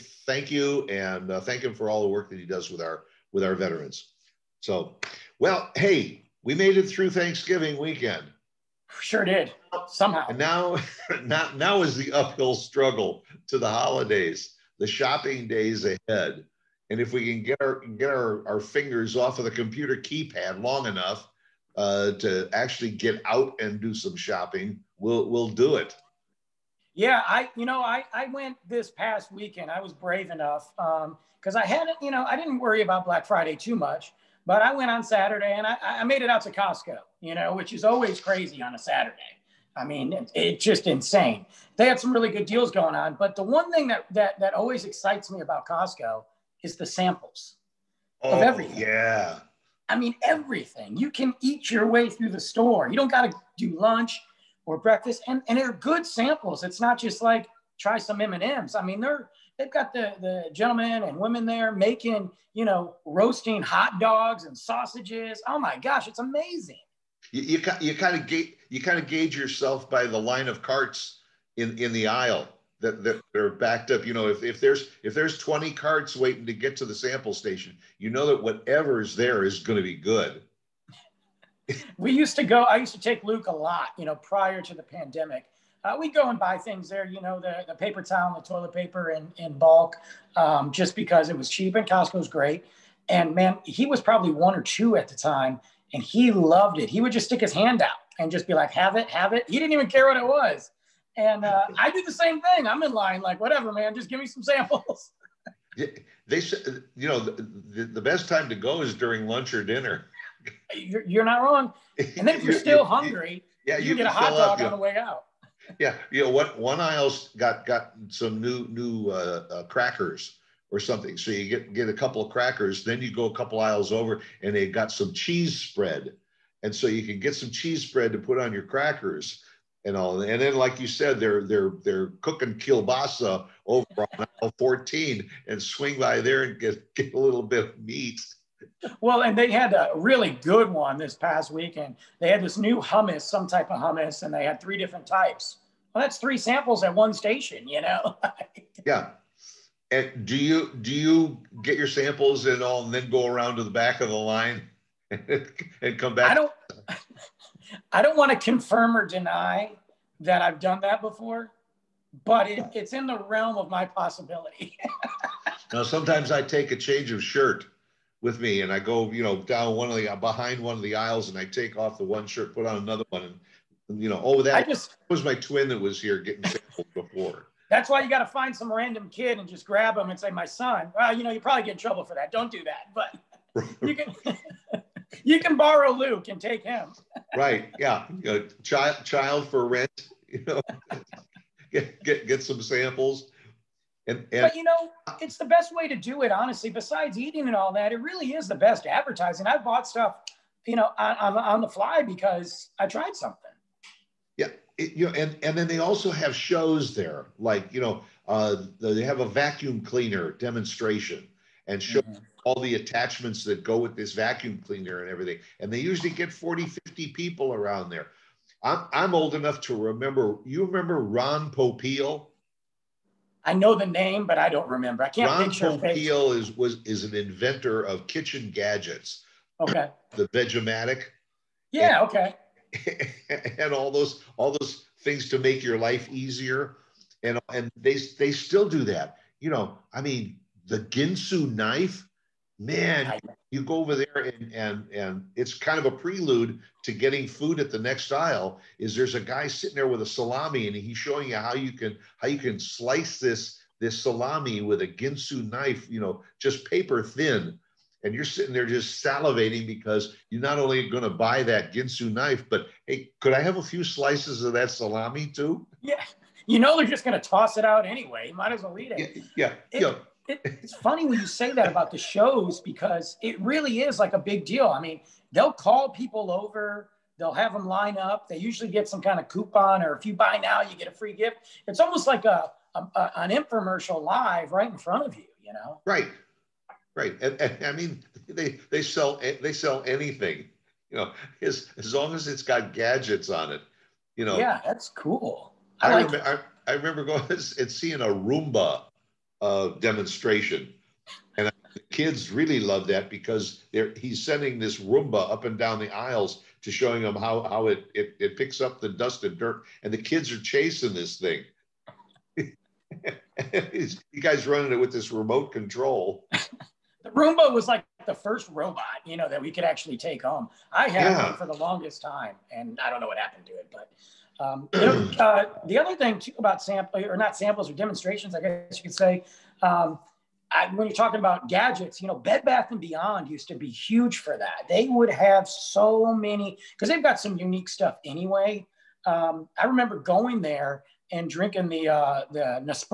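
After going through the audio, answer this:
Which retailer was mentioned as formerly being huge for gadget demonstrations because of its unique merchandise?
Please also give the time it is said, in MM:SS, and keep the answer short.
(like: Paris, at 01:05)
Bed Bath and Beyond, at 05:32.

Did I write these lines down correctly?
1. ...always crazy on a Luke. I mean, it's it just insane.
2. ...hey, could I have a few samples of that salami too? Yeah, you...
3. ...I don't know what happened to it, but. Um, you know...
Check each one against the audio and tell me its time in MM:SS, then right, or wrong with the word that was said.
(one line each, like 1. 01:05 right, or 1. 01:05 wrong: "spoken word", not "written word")
1. 00:37 wrong: "Saturday", not "Luke"
2. 04:22 wrong: "slices", not "samples"
3. 05:22 right.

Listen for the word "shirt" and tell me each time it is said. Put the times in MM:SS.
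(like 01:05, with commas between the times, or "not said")
02:47, 02:52.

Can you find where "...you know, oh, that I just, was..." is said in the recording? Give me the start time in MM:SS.
02:54.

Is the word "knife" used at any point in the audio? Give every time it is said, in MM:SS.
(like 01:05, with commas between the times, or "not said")
04:01, 04:15, 04:22.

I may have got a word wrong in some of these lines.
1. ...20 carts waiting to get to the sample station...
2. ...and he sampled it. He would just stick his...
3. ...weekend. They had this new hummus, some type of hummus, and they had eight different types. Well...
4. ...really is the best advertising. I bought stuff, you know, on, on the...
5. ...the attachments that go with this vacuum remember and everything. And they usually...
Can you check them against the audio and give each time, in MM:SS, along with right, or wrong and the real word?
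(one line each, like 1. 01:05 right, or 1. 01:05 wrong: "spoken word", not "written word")
1. 01:15 right
2. 01:35 wrong: "loved", not "sampled"
3. 02:21 wrong: "three", not "eight"
4. 03:17 right
5. 03:32 wrong: "cleaner", not "remember".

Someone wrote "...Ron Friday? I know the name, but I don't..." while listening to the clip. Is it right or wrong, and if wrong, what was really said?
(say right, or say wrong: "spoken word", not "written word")
wrong: "Popeil", not "Friday".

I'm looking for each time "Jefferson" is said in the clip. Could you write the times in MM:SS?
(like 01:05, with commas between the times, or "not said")
not said.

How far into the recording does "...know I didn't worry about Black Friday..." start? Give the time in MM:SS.
00:32.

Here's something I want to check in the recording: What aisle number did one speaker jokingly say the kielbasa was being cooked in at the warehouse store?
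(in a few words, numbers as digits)
14.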